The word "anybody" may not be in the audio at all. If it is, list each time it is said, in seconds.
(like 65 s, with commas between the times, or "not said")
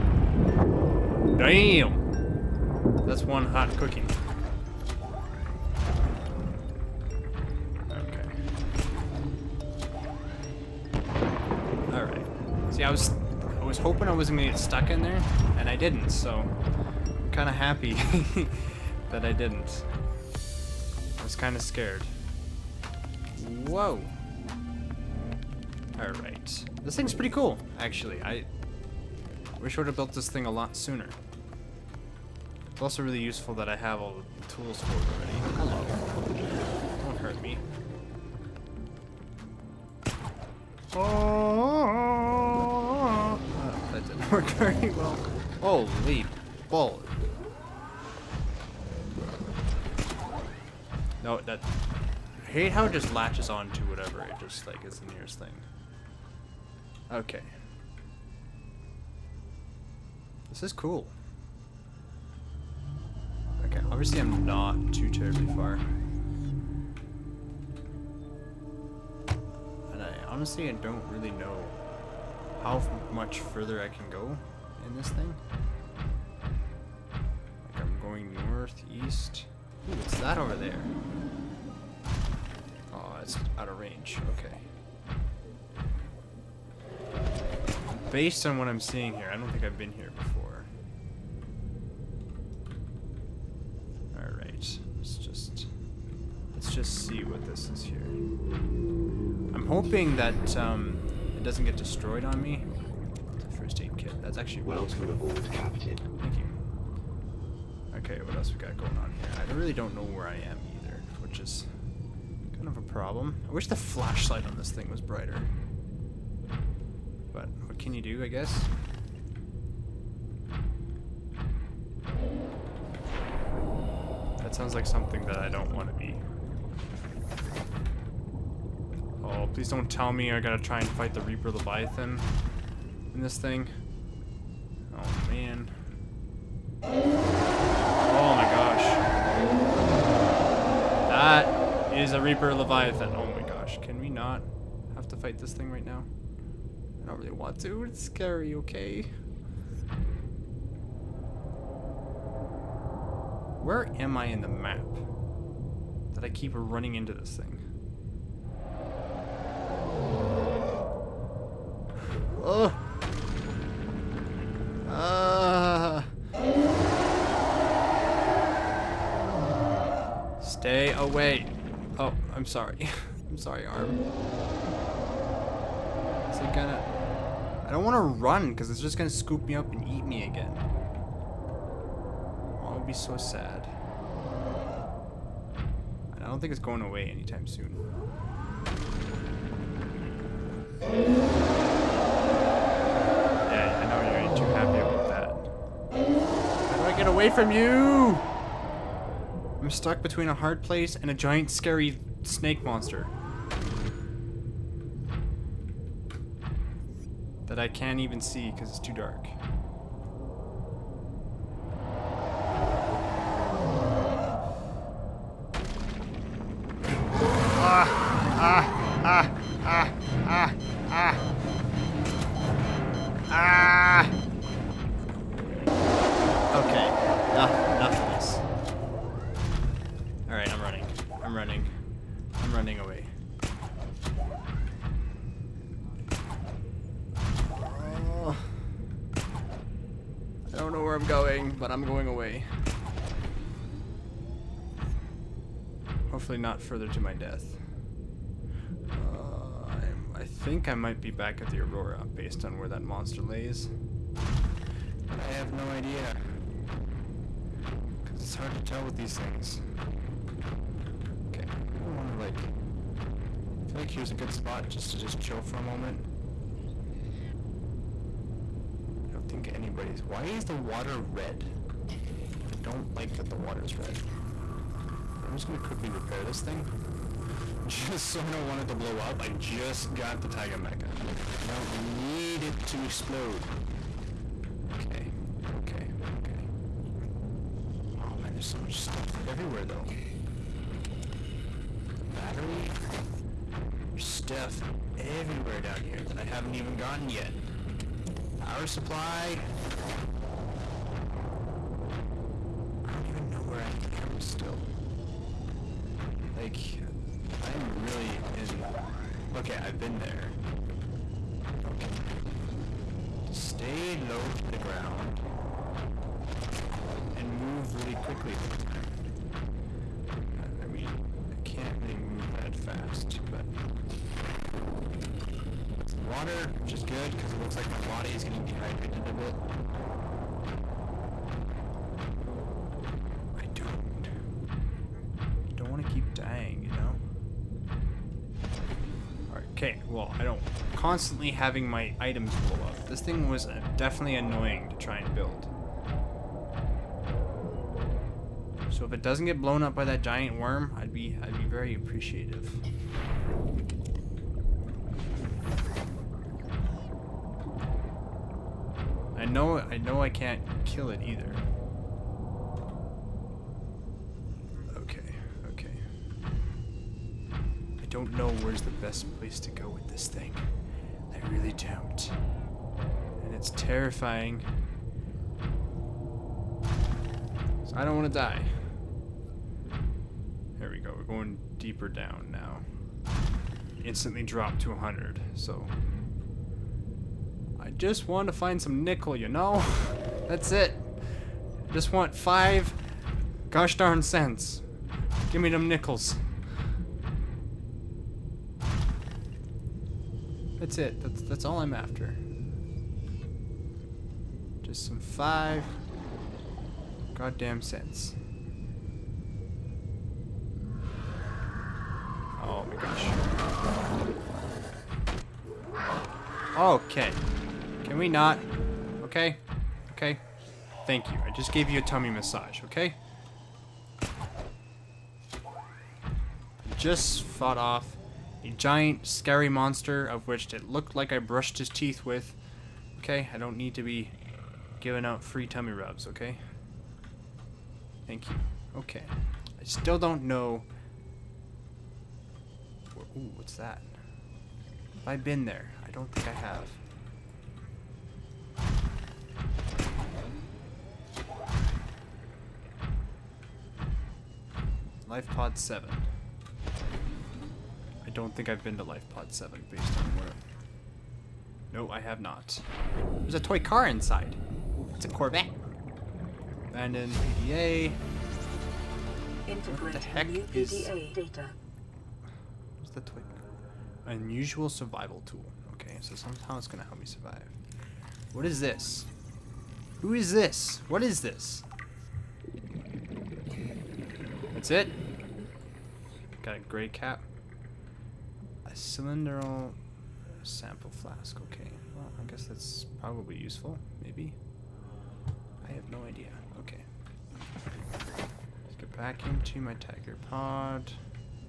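269 s.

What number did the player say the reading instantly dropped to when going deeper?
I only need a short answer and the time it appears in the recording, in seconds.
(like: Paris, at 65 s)
100, at 384 s.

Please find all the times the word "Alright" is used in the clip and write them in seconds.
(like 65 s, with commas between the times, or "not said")
11 s, 25 s.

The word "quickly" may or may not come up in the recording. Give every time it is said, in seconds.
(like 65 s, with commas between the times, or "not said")
275 s, 317 s.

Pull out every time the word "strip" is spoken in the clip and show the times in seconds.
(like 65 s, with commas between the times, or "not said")
not said.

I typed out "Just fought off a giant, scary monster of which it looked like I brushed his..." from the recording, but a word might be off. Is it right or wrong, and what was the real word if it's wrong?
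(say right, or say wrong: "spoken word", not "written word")
right.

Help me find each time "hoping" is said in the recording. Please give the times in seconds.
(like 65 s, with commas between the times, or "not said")
13 s, 99 s.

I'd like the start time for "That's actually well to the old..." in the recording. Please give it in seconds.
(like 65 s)
104 s.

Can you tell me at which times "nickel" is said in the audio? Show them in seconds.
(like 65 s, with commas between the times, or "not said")
388 s, 395 s.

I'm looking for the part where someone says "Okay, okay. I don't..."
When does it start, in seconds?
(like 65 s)
364 s.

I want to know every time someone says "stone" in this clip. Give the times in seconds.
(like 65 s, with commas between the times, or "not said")
not said.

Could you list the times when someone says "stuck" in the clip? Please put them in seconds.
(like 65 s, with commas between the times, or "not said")
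14 s, 199 s.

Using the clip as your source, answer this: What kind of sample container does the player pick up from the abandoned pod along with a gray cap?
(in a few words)
Cylindrical sample flask.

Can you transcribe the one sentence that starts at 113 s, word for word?
I wish the flashlight on this thing was brighter.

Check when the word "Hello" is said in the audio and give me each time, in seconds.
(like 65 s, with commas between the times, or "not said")
35 s.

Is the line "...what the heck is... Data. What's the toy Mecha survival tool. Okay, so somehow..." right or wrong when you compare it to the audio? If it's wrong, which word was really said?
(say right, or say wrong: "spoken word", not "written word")
wrong: "Unusual", not "Mecha".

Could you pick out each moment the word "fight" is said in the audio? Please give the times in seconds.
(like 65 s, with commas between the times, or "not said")
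130 s, 145 s.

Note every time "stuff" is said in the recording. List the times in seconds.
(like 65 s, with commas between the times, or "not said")
288 s, 294 s.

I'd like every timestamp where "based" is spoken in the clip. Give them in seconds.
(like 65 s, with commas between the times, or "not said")
88 s, 252 s, 459 s.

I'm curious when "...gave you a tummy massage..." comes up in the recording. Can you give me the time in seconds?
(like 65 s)
421 s.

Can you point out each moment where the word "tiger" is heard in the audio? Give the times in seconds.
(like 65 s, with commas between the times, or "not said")
280 s, 499 s.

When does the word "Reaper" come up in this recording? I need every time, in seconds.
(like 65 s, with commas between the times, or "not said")
131 s, 142 s.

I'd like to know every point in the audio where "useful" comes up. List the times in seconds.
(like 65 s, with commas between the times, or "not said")
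33 s, 493 s.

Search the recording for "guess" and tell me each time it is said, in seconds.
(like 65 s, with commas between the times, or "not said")
118 s, 492 s.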